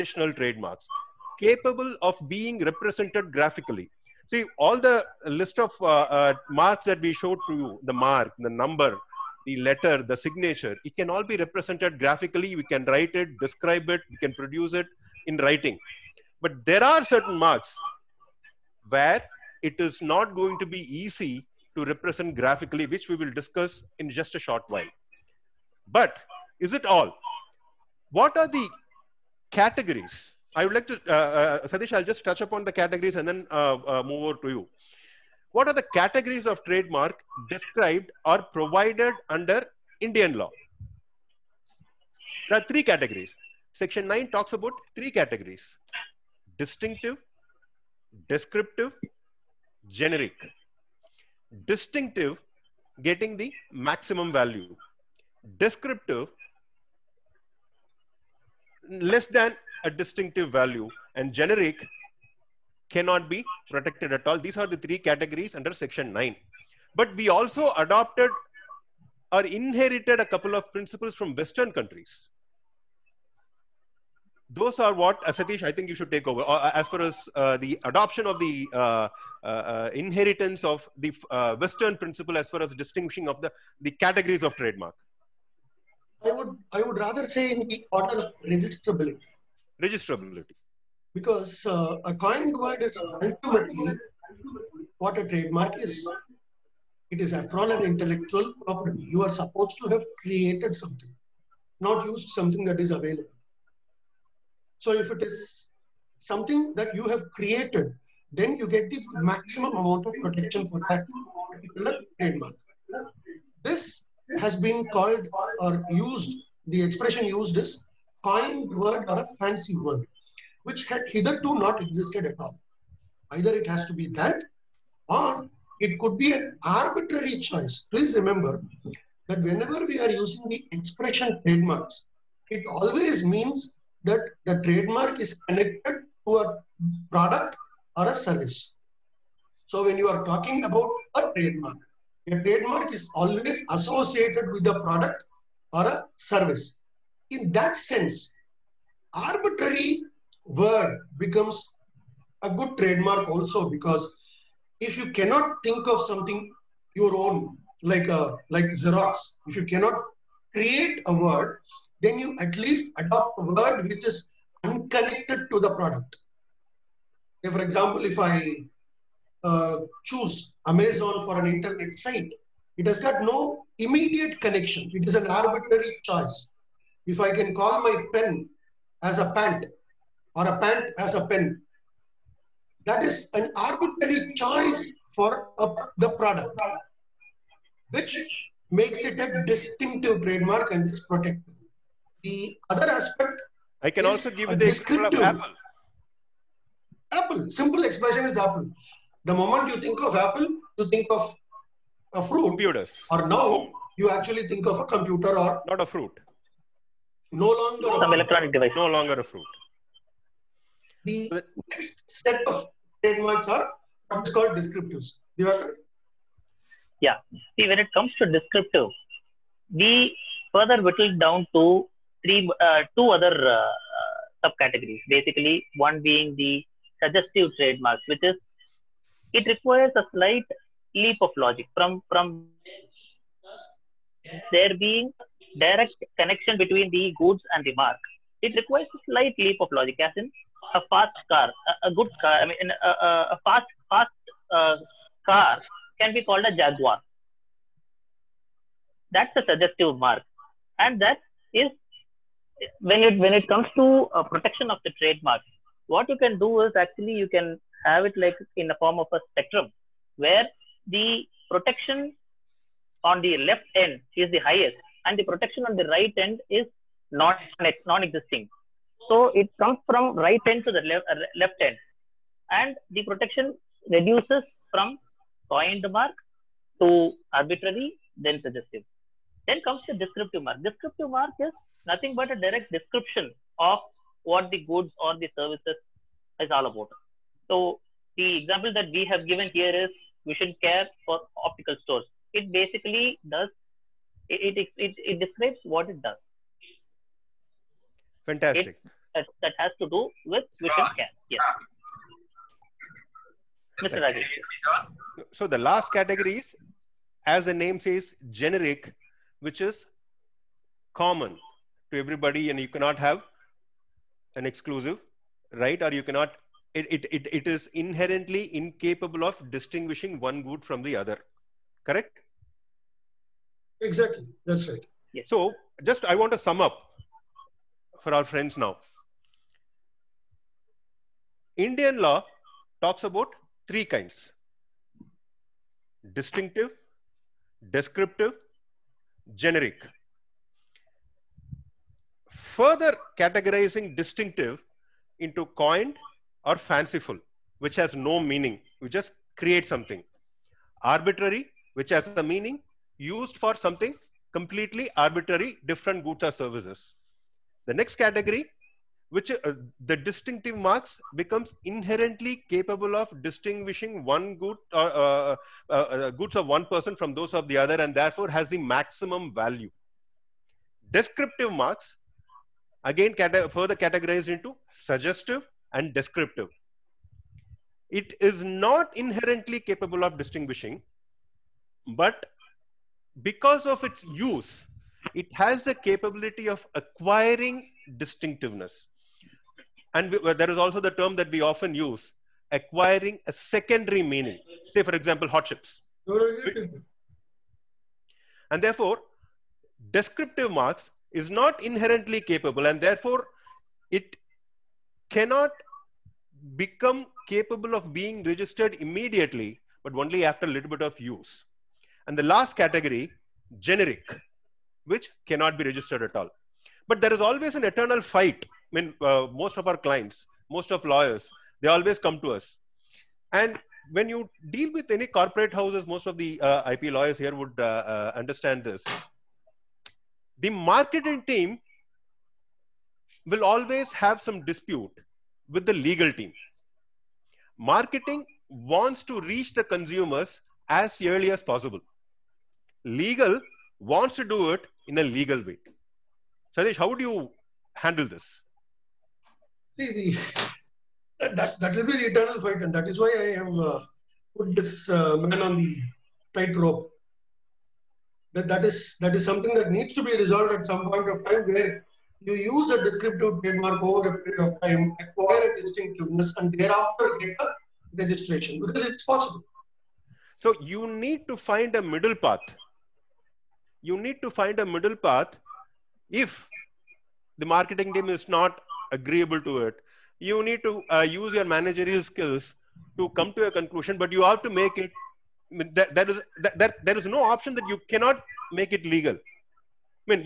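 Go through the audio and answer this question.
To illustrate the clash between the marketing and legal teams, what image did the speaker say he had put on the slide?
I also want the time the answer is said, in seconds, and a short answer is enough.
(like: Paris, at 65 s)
Man on the tightrope, at 455 s.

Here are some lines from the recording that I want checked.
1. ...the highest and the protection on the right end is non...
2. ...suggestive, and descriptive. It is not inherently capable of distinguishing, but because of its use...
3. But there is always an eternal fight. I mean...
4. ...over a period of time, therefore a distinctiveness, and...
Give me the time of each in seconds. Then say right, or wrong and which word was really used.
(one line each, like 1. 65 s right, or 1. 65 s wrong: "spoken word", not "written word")
1. 264 s right
2. 374 s right
3. 416 s right
4. 463 s wrong: "acquire", not "therefore".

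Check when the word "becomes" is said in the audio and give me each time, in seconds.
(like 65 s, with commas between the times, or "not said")
151 s, 361 s, 406 s.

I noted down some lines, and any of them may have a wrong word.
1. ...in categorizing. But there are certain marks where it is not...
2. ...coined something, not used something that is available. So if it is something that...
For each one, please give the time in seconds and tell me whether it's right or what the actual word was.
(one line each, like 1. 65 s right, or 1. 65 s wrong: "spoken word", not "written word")
1. 15 s wrong: "writing", not "categorizing"
2. 100 s wrong: "created", not "coined".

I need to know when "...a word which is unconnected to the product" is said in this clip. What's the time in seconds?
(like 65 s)
163 s.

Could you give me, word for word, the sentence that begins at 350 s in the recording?
Arbitrary, which has a meaning, used for something completely arbitrary, different goods or services.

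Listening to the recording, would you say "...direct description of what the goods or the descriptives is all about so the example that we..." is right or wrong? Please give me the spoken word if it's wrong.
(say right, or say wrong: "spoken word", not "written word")
wrong: "services", not "descriptives".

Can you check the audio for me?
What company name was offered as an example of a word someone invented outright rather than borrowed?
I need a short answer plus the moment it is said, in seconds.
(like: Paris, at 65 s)
Xerox, at 158 s.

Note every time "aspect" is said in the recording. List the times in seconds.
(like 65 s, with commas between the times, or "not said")
192 s.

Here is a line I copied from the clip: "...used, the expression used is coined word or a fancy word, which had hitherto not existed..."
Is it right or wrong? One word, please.
right.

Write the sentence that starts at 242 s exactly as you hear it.
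I mean, a, a, a fast fast uh, car can be called a Jaguar.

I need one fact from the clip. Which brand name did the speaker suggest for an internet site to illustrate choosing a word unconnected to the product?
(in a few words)
Amazon.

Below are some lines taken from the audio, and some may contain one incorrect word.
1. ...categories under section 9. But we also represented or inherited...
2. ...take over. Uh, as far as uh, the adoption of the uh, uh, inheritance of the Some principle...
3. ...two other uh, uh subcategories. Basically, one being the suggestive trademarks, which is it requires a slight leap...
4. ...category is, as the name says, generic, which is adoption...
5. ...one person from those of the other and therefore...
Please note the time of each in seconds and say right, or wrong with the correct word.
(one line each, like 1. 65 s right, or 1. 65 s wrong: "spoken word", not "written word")
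1. 64 s wrong: "adopted", not "represented"
2. 76 s wrong: "Western", not "Some"
3. 222 s right
4. 305 s wrong: "common", not "adoption"
5. 366 s right.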